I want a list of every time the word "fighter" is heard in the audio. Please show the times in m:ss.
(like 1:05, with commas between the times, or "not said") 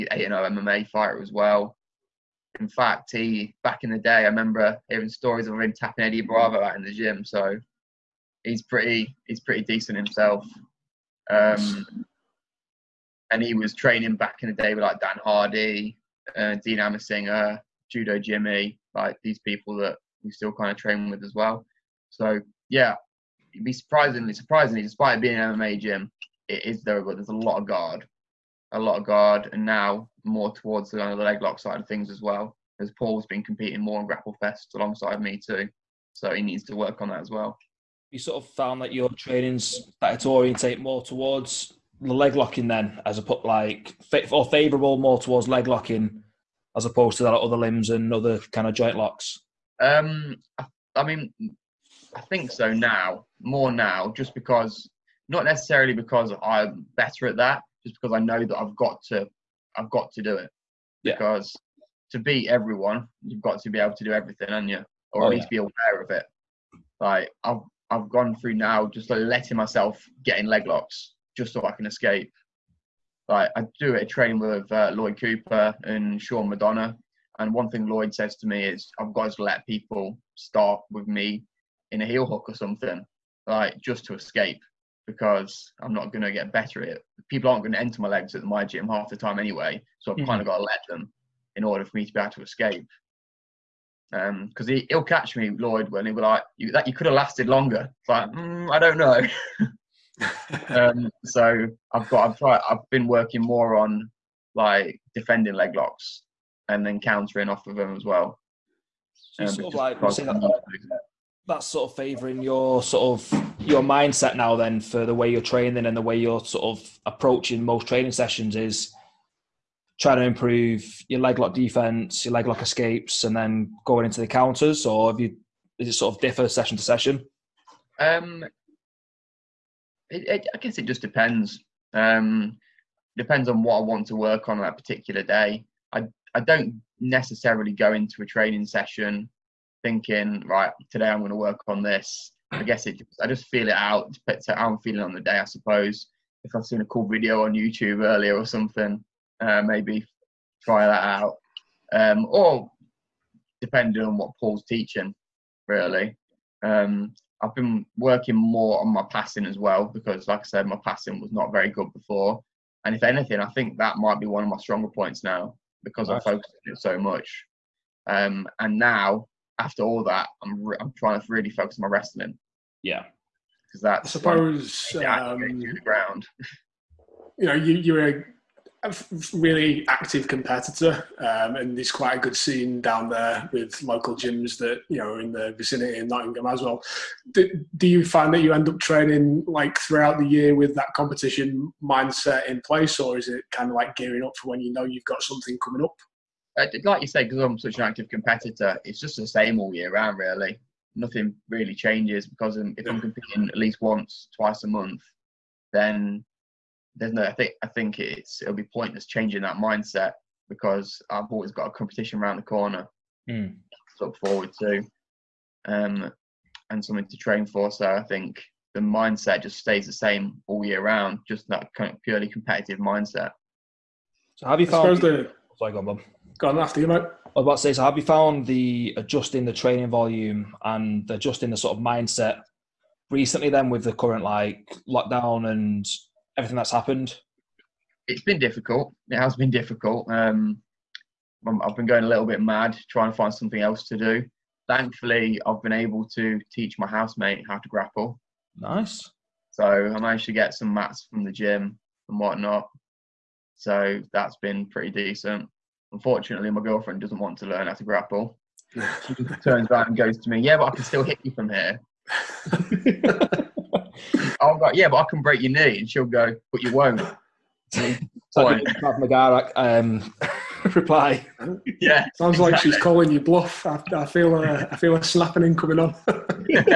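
0:00.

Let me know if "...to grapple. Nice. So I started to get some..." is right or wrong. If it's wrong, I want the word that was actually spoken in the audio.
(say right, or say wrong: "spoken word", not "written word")
wrong: "managed", not "started".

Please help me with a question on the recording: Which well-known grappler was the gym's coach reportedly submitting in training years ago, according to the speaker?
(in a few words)
Eddie Bravo.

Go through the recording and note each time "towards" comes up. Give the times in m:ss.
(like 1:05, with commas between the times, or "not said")
0:30, 0:41, 0:45.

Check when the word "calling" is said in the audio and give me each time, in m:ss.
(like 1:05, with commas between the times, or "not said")
4:32.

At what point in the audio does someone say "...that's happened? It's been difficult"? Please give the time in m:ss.
3:56.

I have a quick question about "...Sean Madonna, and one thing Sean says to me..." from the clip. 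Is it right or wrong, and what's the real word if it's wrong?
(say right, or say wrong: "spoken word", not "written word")
wrong: "Lloyd", not "Sean".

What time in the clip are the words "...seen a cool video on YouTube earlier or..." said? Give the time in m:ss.
2:26.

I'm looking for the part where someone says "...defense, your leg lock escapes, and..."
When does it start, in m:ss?
2:01.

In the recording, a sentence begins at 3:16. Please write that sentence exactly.
Uh, like you said, because I'm such an active competitor, it's just the same all year round, really.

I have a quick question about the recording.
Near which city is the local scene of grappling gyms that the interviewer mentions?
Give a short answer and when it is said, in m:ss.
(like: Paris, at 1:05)
Nottingham, at 3:06.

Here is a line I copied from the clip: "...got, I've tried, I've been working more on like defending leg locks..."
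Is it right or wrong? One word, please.
right.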